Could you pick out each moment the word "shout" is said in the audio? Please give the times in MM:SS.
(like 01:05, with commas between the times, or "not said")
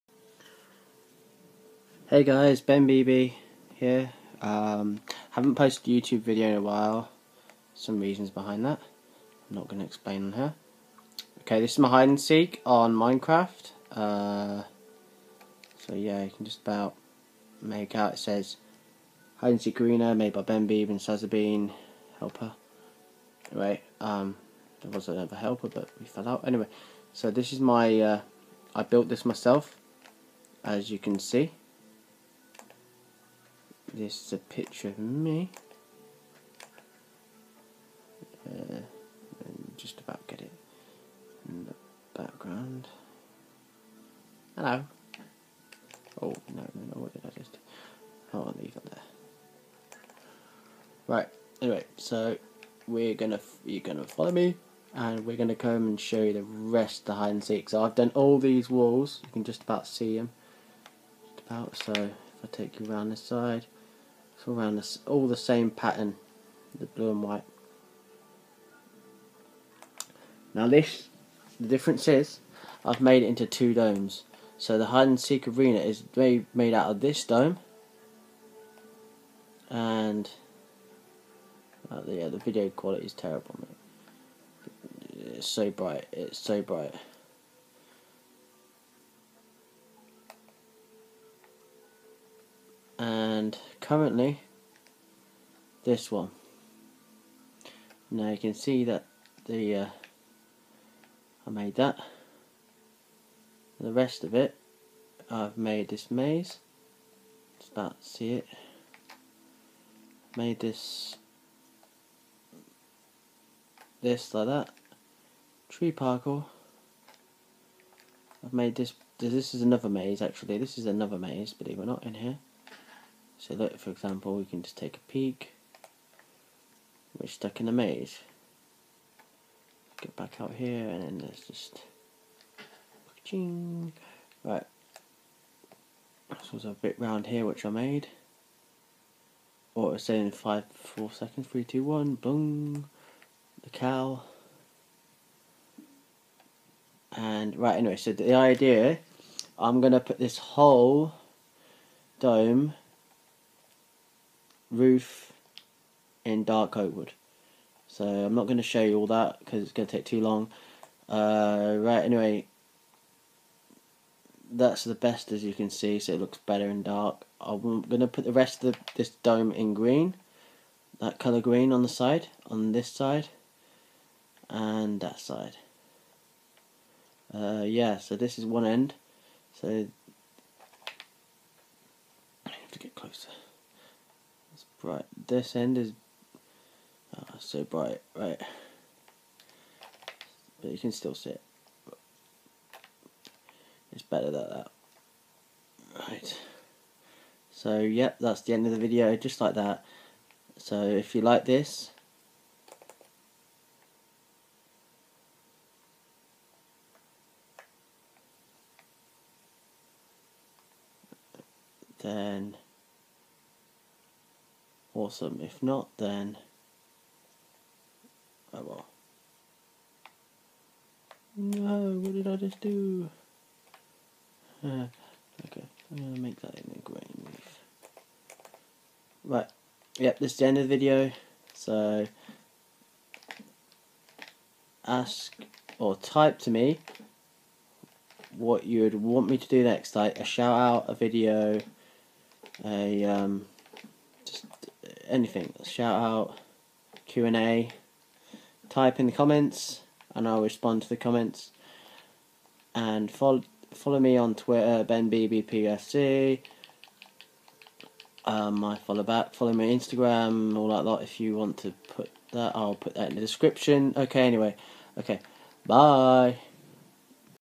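04:00, 04:05.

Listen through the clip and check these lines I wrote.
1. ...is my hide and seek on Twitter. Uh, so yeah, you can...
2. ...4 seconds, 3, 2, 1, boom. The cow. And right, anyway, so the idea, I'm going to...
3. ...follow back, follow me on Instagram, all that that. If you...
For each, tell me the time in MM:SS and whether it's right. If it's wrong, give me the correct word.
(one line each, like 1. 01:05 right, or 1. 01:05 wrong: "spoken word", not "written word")
1. 00:11 wrong: "Minecraft", not "Twitter"
2. 02:20 right
3. 04:18 right.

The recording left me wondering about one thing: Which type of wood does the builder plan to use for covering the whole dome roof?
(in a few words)
dark oak.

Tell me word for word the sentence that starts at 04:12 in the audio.
And follow follow me on Twitter, BenBBPFC.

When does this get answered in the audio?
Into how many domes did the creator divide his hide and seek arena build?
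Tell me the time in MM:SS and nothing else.
01:13.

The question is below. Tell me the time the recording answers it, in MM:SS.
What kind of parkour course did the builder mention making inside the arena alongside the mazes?
01:55.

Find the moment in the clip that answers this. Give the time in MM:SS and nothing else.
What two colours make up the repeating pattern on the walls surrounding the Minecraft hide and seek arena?
01:06.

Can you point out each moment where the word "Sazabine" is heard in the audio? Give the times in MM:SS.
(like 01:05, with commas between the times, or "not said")
00:20.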